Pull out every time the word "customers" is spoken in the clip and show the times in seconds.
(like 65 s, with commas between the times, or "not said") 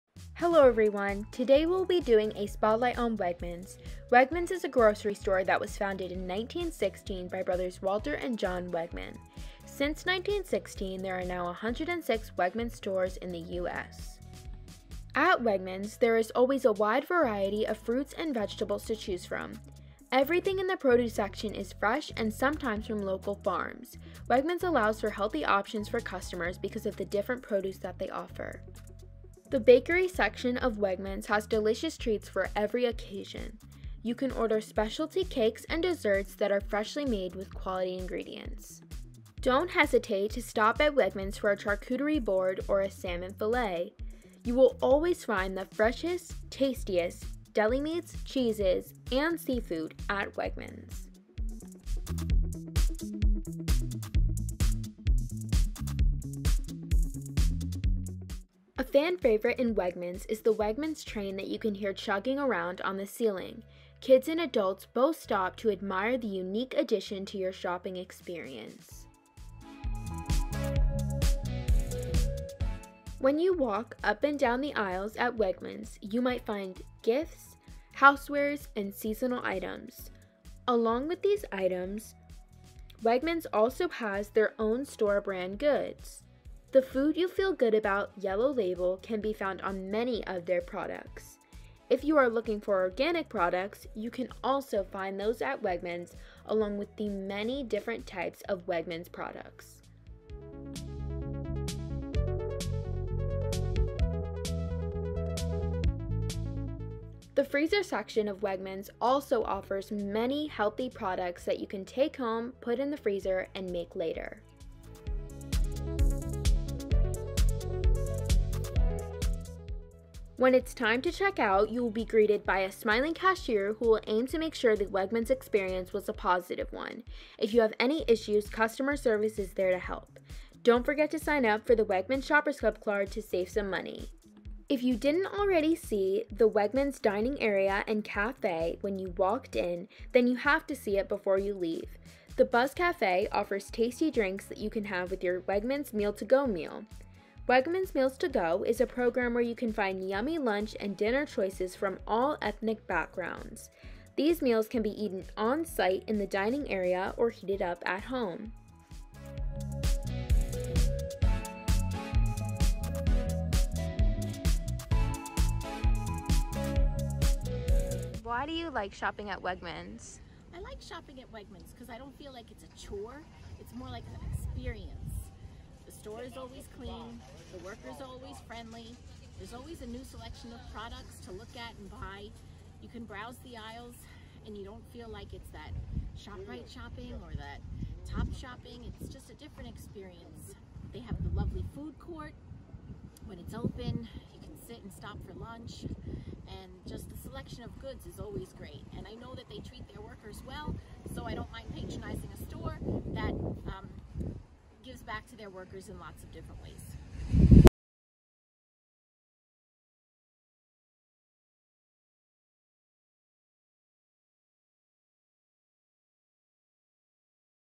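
25 s, 128 s.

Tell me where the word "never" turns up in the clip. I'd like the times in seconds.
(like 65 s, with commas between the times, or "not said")
not said.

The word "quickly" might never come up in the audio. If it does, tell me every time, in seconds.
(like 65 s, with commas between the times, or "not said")
not said.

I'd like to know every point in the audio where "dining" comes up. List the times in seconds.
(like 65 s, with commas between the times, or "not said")
136 s, 156 s.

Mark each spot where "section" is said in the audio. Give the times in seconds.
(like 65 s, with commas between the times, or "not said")
21 s, 30 s, 107 s.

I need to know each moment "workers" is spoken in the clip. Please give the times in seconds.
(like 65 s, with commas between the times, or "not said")
177 s, 200 s, 205 s.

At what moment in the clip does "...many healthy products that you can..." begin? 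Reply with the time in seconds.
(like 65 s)
109 s.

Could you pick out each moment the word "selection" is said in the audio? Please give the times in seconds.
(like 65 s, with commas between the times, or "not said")
180 s, 197 s.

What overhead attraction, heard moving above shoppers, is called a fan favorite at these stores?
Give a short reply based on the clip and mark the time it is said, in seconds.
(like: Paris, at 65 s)
Wegmans train, at 60 s.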